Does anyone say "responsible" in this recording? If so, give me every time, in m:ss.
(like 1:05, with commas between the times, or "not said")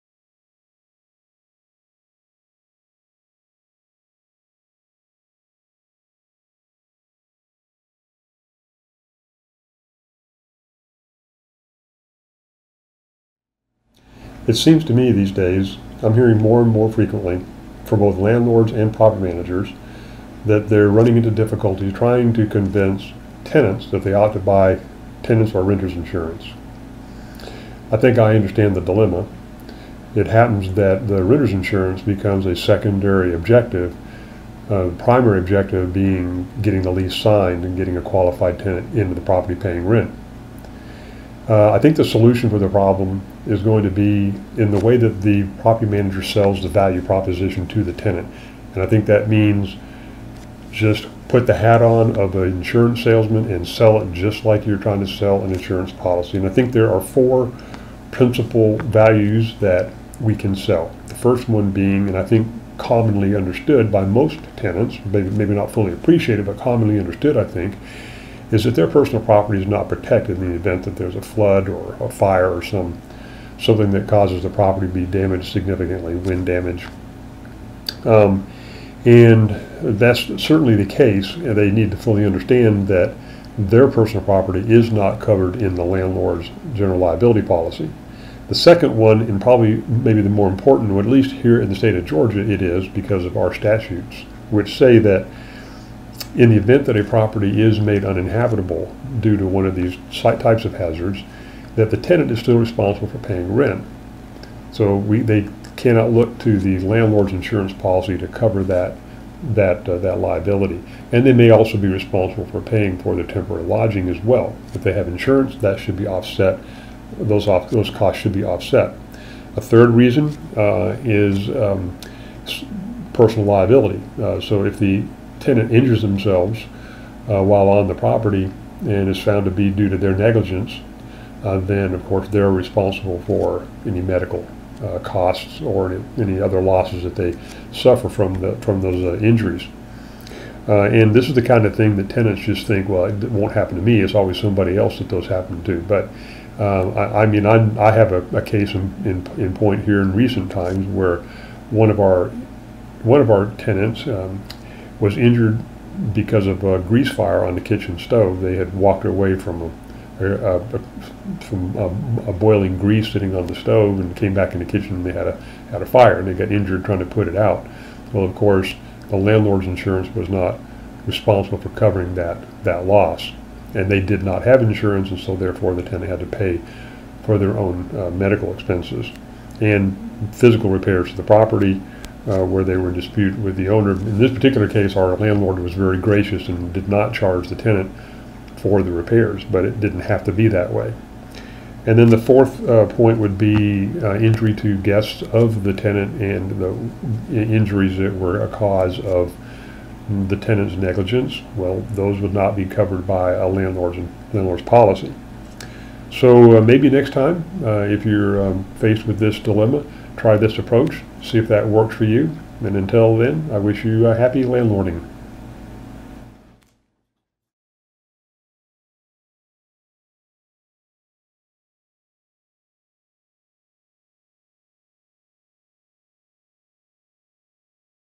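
1:42, 1:51, 2:12, 2:51.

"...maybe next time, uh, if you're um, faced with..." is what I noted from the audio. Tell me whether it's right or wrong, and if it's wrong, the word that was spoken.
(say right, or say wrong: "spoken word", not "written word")
right.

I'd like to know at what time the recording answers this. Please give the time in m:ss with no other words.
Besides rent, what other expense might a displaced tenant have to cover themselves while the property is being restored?
1:53.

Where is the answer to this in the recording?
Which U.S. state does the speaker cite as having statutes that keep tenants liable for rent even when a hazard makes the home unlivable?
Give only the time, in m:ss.
1:32.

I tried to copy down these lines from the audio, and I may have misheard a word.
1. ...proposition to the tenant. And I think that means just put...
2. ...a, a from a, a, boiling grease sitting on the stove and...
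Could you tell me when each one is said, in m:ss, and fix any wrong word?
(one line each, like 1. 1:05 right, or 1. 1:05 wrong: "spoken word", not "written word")
1. 0:47 right
2. 2:40 right.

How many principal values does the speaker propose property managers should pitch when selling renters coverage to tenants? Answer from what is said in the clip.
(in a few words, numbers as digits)
4.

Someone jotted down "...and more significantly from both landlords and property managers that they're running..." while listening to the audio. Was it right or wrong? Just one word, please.
wrong.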